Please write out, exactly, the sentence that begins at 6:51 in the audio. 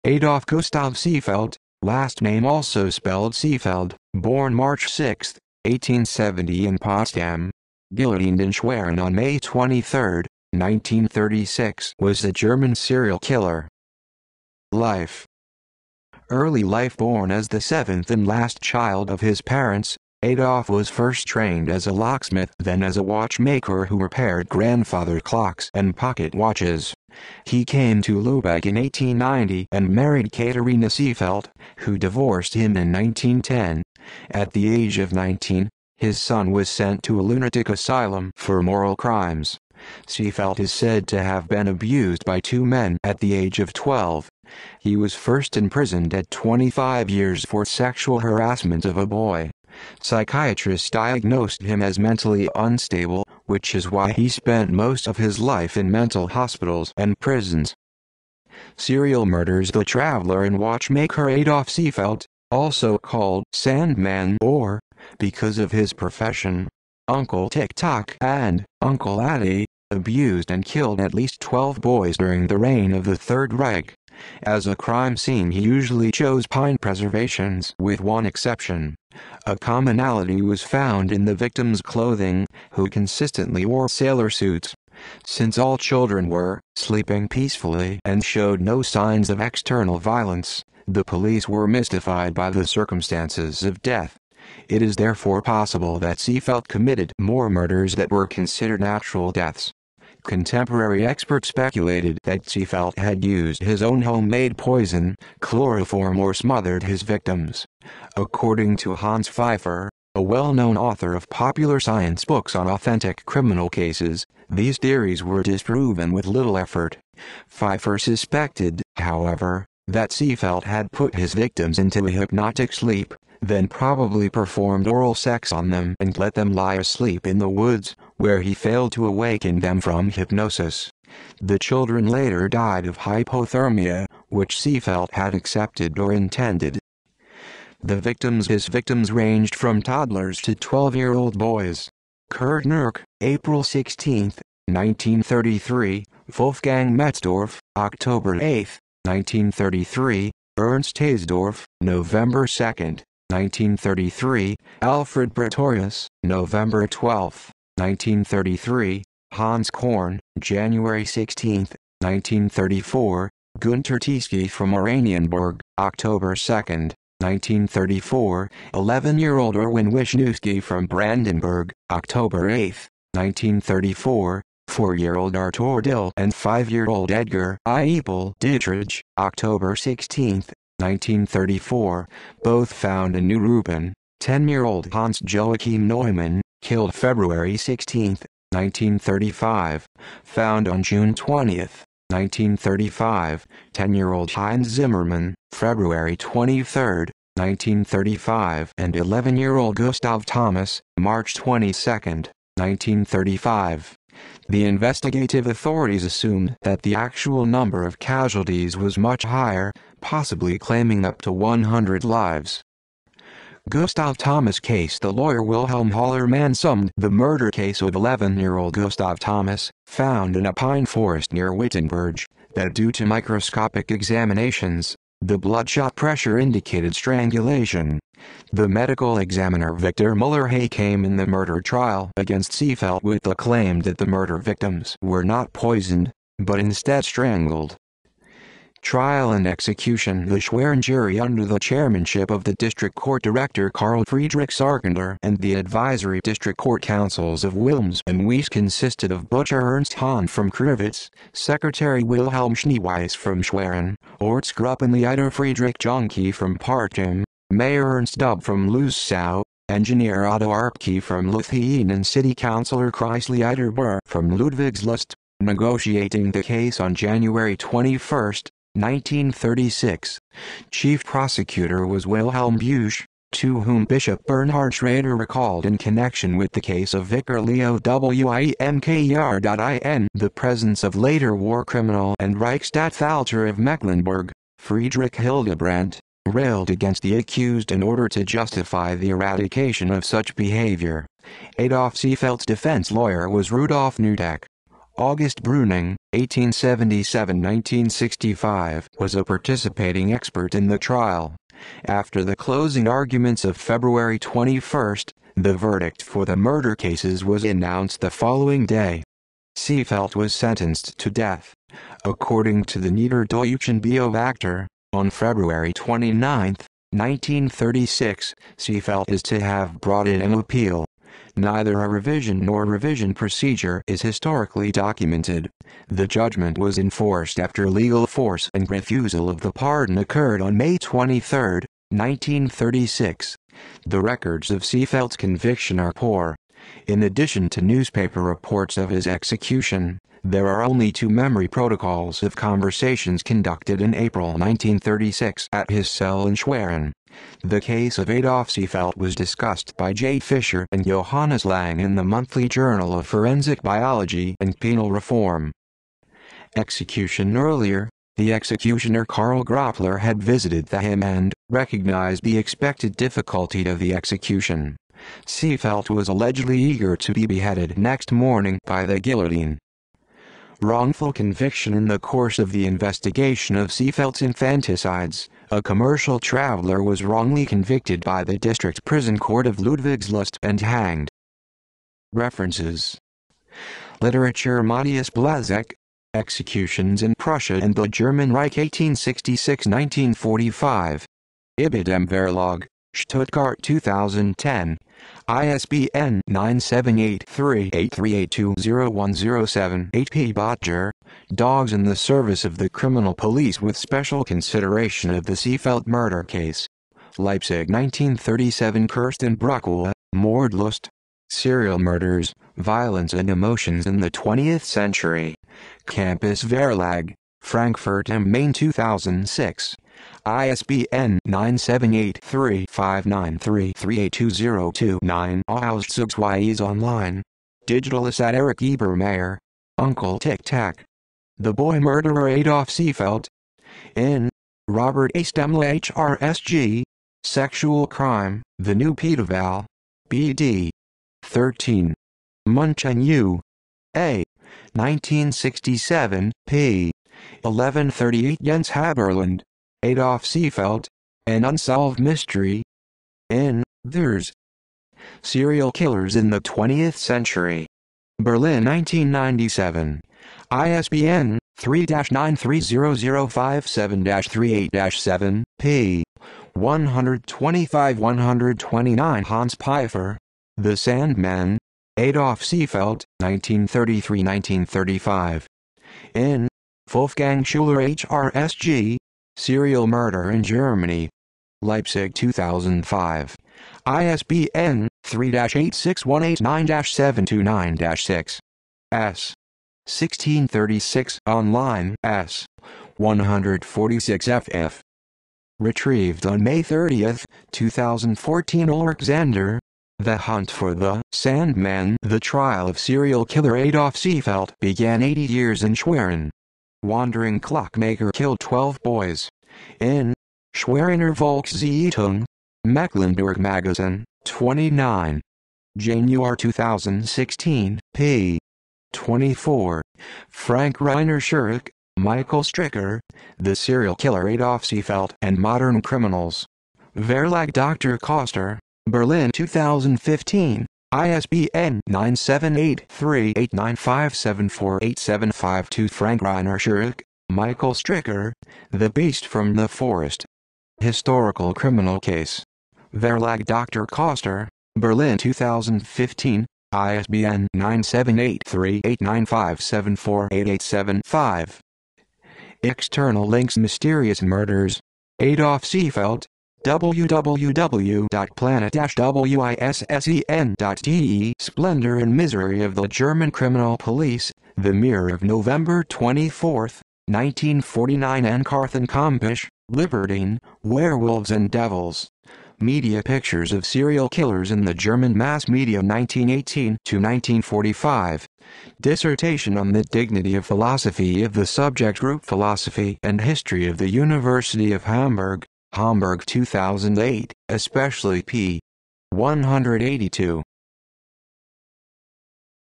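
Serial Murders, Violence and Emotions in the 20th Century.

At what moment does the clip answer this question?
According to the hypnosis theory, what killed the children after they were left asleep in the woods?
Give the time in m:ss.
2:12.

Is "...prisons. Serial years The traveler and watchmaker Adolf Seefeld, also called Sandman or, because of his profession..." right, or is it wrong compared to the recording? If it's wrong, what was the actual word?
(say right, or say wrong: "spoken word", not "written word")
wrong: "murders", not "years".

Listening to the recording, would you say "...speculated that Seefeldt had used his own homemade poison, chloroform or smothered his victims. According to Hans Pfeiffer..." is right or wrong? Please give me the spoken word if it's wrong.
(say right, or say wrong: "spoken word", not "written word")
right.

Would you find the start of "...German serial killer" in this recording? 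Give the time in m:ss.
0:12.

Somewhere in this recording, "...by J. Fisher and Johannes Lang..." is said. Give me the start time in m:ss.
5:49.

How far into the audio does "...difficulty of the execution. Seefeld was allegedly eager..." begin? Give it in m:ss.
6:02.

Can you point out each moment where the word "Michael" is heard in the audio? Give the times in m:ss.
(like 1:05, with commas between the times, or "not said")
8:41, 8:57.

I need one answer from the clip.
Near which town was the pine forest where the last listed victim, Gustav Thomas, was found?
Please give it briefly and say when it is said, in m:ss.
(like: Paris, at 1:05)
Wittenberg, at 3:41.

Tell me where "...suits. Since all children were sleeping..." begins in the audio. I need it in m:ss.
1:24.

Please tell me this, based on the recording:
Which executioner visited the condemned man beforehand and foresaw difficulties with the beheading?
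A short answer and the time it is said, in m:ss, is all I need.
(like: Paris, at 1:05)
Karl Groppler, at 5:59.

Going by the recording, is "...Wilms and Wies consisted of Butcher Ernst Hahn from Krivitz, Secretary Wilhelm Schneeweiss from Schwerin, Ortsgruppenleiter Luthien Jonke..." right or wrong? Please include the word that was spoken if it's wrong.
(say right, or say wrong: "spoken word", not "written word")
wrong: "Friedrich", not "Luthien".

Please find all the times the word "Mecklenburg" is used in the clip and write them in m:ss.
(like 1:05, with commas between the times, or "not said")
4:43, 8:32.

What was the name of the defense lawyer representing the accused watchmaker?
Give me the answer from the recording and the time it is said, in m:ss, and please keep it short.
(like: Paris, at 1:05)
Rudolf Nudak, at 4:53.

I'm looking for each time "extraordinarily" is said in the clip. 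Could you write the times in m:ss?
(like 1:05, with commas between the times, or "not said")
not said.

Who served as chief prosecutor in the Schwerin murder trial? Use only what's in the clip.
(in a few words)
Wilhelm Busch.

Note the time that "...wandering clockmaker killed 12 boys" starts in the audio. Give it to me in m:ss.
8:26.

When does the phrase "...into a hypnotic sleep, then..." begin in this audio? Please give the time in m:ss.
2:01.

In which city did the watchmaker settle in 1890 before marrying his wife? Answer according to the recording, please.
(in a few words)
Lubeck.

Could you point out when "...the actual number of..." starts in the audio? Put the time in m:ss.
3:26.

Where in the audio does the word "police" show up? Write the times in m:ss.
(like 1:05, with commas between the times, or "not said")
1:31, 6:43, 9:23.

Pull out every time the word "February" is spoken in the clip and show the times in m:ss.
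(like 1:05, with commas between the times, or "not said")
3:06, 3:15, 5:03, 5:15.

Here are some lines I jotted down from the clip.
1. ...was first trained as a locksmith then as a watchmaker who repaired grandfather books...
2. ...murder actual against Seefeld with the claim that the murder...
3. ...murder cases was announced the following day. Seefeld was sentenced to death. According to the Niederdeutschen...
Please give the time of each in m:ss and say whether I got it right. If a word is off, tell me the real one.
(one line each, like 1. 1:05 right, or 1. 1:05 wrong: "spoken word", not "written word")
1. 0:20 wrong: "clocks", not "books"
2. 3:51 wrong: "trial", not "actual"
3. 5:06 right.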